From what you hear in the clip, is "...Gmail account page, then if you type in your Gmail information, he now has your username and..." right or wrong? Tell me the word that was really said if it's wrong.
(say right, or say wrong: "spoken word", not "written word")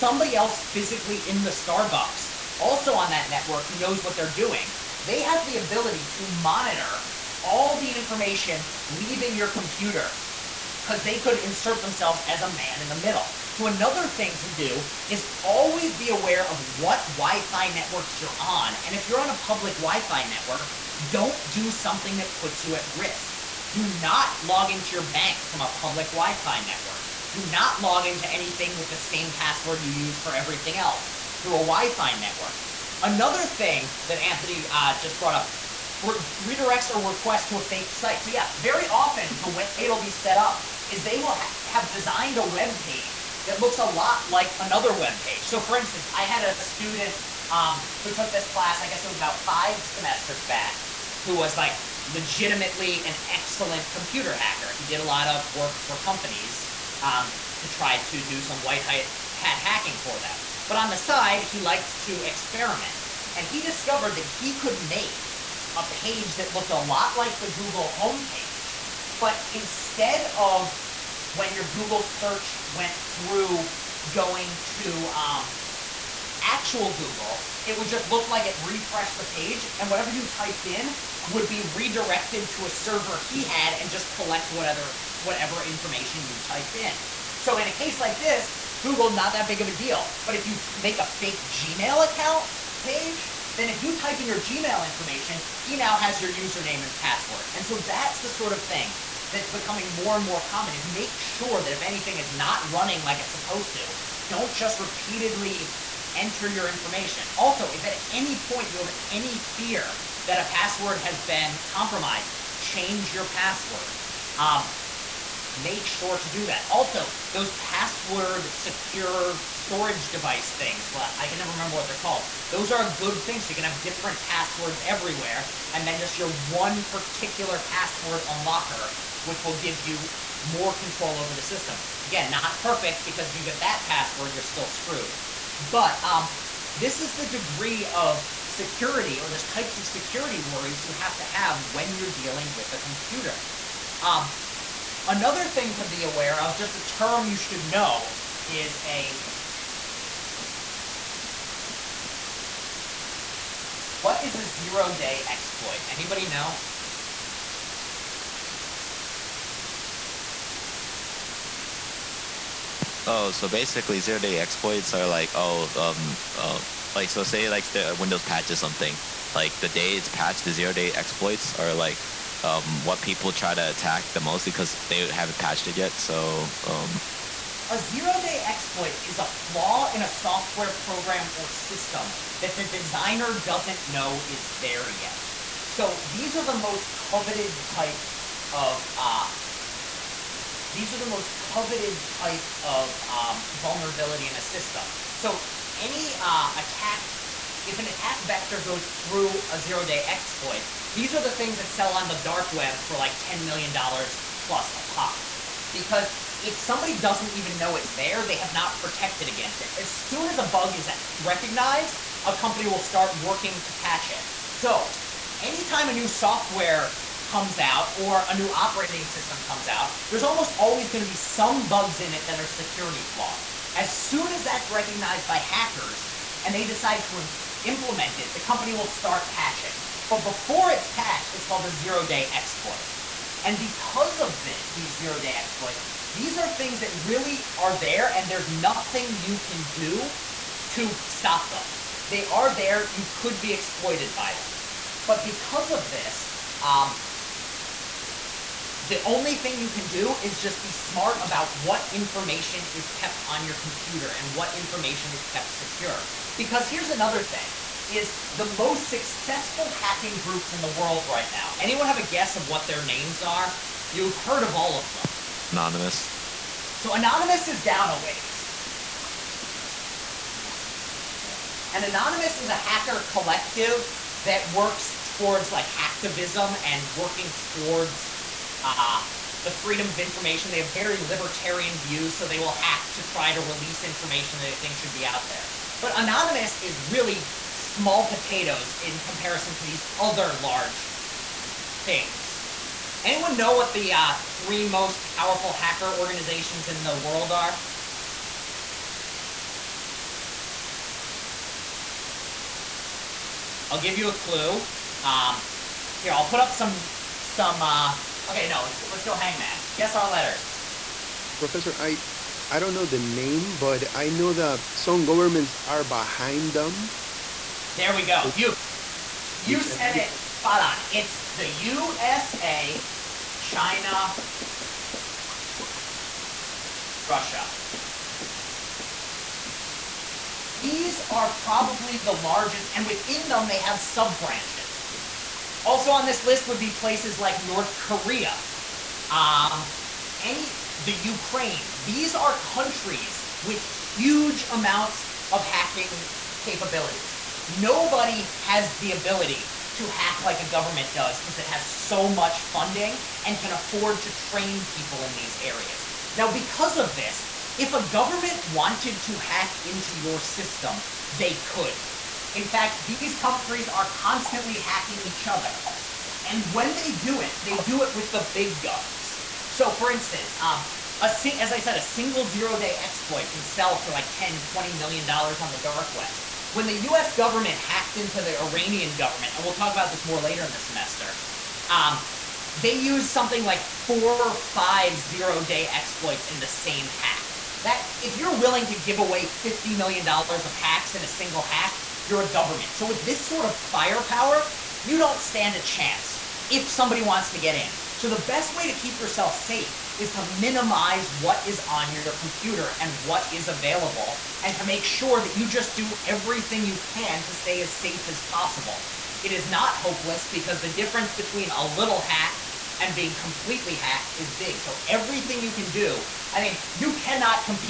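right.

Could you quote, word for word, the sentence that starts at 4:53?
Anyone know what the uh, three most powerful hacker organizations in the world are?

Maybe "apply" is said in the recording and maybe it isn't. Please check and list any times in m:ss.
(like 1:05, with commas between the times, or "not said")
not said.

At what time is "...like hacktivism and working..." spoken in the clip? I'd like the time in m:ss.
4:35.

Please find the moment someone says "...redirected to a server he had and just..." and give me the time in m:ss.
1:21.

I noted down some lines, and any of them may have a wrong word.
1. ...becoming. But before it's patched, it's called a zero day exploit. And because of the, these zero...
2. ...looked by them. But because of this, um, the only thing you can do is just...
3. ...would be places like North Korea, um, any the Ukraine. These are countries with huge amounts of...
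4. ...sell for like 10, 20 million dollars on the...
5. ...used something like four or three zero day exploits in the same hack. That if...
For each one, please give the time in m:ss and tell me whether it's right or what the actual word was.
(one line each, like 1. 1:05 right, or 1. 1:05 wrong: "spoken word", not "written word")
1. 3:49 wrong: "patching", not "becoming"
2. 4:03 wrong: "exploited", not "looked"
3. 5:36 right
4. 6:13 right
5. 6:22 wrong: "five", not "three".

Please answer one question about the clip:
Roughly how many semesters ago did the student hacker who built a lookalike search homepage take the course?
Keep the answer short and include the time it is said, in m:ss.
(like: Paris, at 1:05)
5, at 0:49.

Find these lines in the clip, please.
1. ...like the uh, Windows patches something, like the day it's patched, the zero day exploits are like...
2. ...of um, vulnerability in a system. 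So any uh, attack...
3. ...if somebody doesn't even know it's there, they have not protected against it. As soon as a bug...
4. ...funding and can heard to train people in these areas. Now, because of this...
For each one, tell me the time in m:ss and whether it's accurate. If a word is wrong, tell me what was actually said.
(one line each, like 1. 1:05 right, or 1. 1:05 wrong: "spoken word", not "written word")
1. 2:47 right
2. 3:12 right
3. 3:26 right
4. 5:52 wrong: "afford", not "heard".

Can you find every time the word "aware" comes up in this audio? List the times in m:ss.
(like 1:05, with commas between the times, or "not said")
0:16, 2:26.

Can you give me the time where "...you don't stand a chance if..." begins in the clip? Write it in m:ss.
6:34.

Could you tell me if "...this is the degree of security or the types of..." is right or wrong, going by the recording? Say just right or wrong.
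right.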